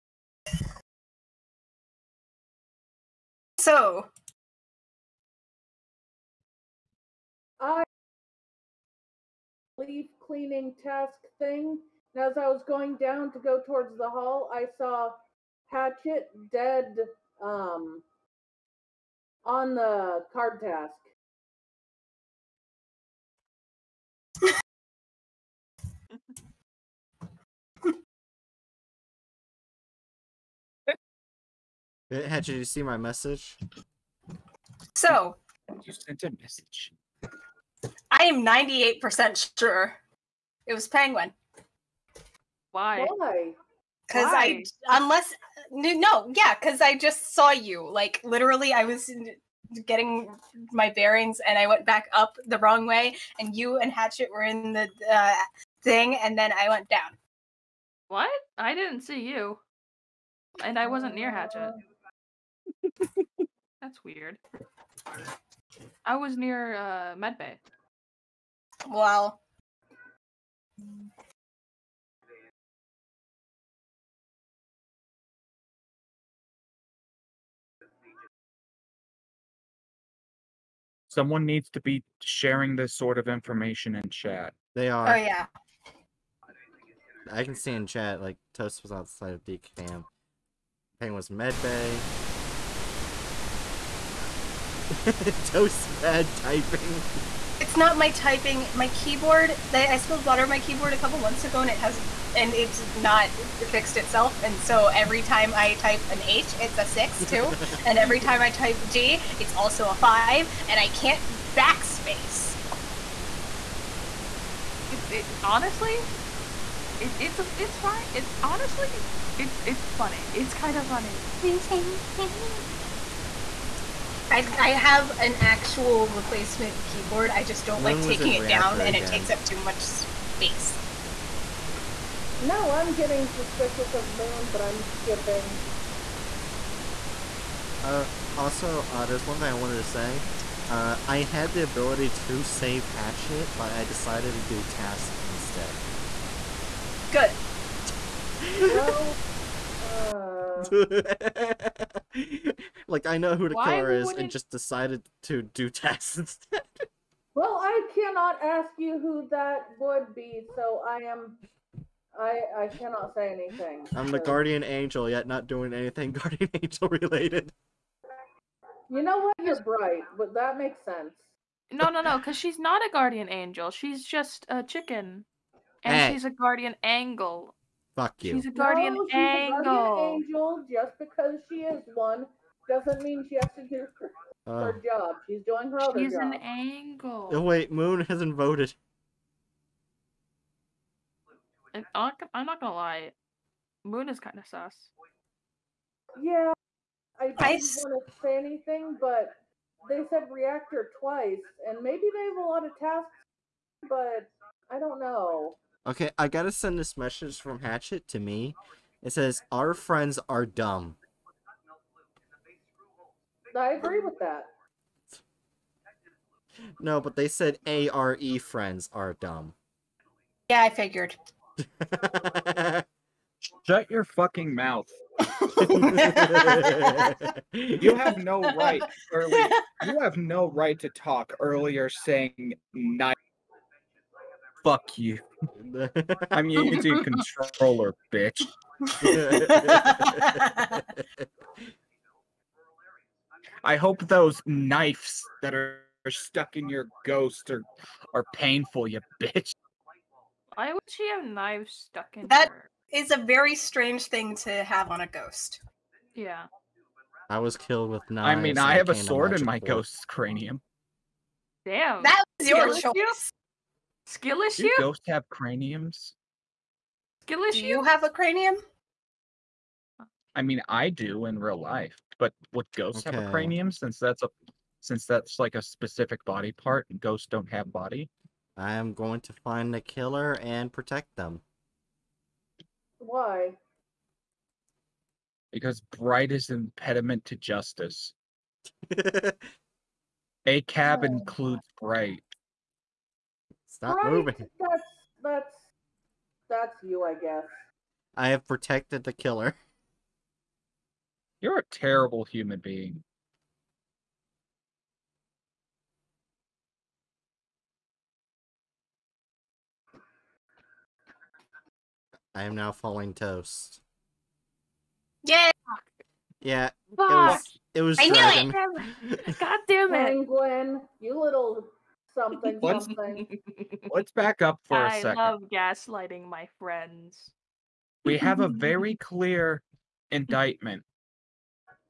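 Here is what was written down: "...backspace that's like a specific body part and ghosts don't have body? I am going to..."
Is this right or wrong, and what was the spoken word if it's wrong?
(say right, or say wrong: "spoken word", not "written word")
wrong: "since", not "backspace".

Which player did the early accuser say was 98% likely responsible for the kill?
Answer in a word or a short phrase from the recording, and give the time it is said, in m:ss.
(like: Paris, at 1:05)
Penguin, at 0:40.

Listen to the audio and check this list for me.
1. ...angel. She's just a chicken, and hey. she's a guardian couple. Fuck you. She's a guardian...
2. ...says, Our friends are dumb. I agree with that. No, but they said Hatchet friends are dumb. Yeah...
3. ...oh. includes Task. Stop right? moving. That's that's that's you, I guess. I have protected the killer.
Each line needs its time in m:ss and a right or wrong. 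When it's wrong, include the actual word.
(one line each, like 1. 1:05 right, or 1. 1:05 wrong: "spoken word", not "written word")
1. 2:53 wrong: "angle", not "couple"
2. 3:29 wrong: "ARE", not "Hatchet"
3. 4:51 wrong: "Bright", not "Task".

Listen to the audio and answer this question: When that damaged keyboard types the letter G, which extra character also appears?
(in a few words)
5.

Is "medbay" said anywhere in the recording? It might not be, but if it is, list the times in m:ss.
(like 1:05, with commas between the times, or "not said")
1:07, 1:31.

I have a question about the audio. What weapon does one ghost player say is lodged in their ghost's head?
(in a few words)
A sword.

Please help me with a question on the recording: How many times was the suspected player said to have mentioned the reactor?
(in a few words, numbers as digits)
2.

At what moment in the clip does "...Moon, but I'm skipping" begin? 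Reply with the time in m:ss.
2:14.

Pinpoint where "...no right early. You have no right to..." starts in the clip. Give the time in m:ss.
3:48.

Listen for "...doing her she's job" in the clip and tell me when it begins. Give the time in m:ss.
3:05.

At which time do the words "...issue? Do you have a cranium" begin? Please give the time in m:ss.
4:27.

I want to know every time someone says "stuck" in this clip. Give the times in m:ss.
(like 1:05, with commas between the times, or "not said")
4:06, 4:11.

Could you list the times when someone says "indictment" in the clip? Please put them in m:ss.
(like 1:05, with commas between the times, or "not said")
5:30.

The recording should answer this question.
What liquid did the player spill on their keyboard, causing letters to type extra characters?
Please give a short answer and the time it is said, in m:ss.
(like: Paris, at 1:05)
Water, at 1:40.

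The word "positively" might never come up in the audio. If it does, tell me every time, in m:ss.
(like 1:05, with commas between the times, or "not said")
not said.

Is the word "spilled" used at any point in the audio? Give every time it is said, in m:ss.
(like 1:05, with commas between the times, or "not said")
1:39.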